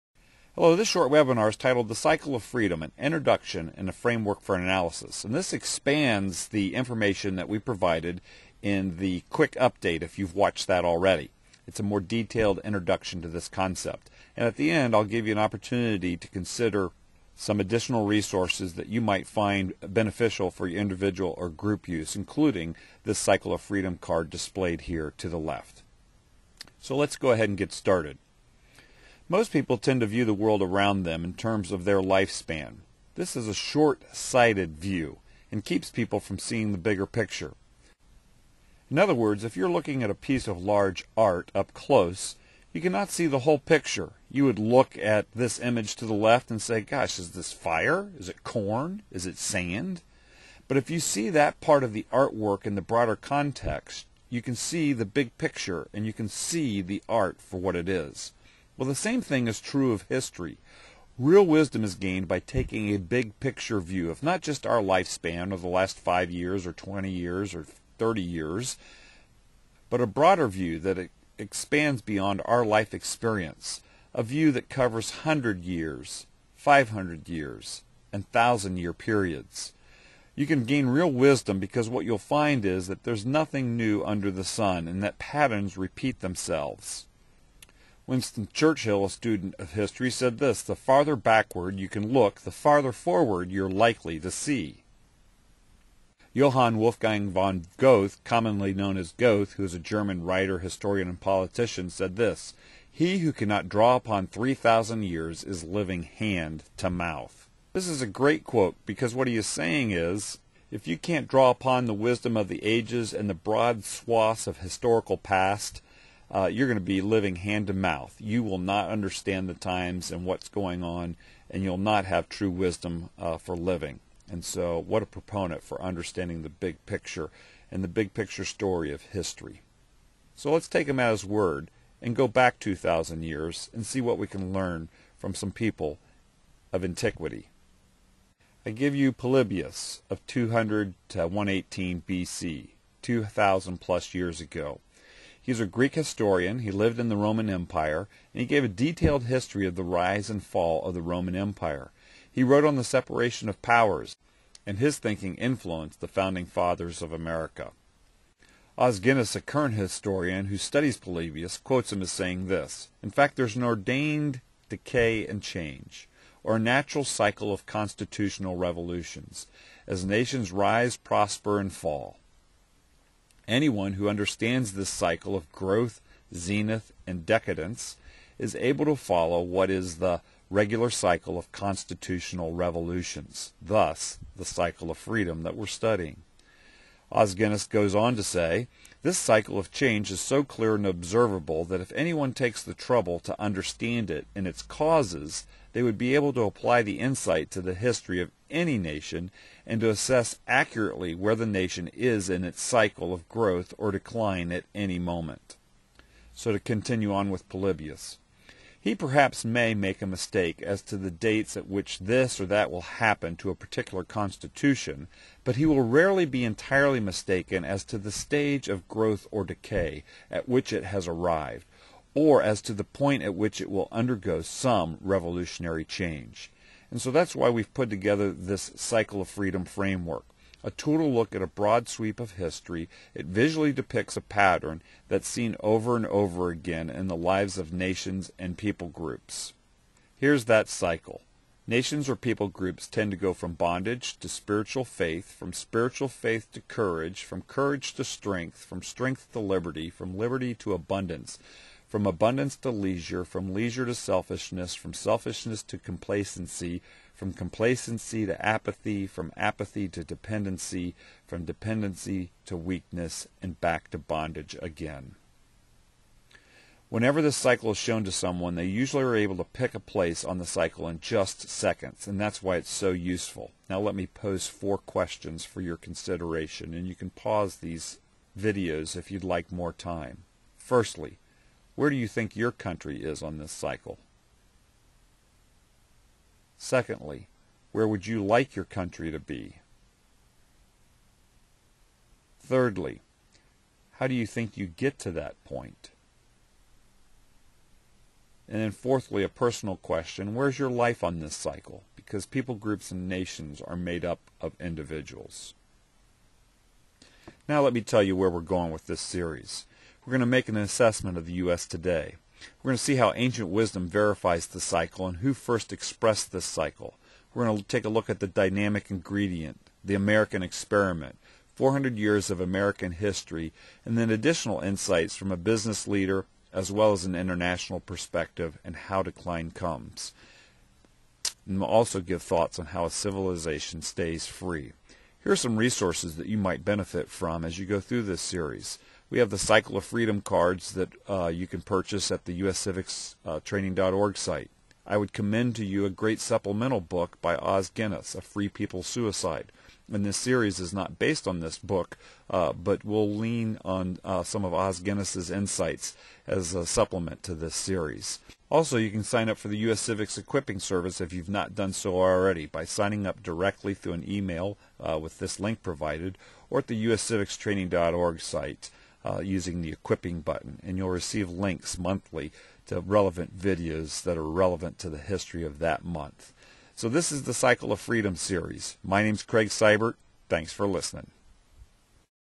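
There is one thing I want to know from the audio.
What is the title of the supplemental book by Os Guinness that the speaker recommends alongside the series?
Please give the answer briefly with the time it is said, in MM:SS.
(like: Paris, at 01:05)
A Free People Suicide, at 05:48.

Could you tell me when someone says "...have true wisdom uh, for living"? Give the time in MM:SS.
02:02.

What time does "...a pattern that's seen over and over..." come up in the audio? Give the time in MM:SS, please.
03:54.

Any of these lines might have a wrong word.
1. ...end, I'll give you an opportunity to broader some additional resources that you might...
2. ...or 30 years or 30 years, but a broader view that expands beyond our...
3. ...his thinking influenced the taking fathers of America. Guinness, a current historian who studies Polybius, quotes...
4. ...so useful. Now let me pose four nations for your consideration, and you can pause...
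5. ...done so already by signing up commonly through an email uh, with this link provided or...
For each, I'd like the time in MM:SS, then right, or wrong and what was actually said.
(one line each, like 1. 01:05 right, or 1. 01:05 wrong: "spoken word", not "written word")
1. 00:14 wrong: "consider", not "broader"
2. 01:06 wrong: "20", not "30"
3. 02:34 wrong: "founding", not "taking"
4. 04:32 wrong: "questions", not "nations"
5. 06:01 wrong: "directly", not "commonly".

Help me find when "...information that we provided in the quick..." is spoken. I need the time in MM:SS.
00:06.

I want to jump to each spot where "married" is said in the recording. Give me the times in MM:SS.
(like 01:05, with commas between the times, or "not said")
not said.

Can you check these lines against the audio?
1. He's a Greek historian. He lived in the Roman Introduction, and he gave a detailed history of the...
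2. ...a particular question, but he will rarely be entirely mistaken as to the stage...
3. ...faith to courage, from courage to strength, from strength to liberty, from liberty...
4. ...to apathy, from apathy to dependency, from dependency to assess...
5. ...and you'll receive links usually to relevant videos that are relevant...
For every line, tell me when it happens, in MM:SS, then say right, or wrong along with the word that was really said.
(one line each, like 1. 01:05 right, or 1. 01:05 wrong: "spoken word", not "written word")
1. 02:25 wrong: "Empire", not "Introduction"
2. 03:33 wrong: "constitution", not "question"
3. 04:06 right
4. 04:18 wrong: "weakness", not "assess"
5. 06:10 wrong: "monthly", not "usually".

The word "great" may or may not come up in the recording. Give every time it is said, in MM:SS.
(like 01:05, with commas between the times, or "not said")
01:48, 05:45.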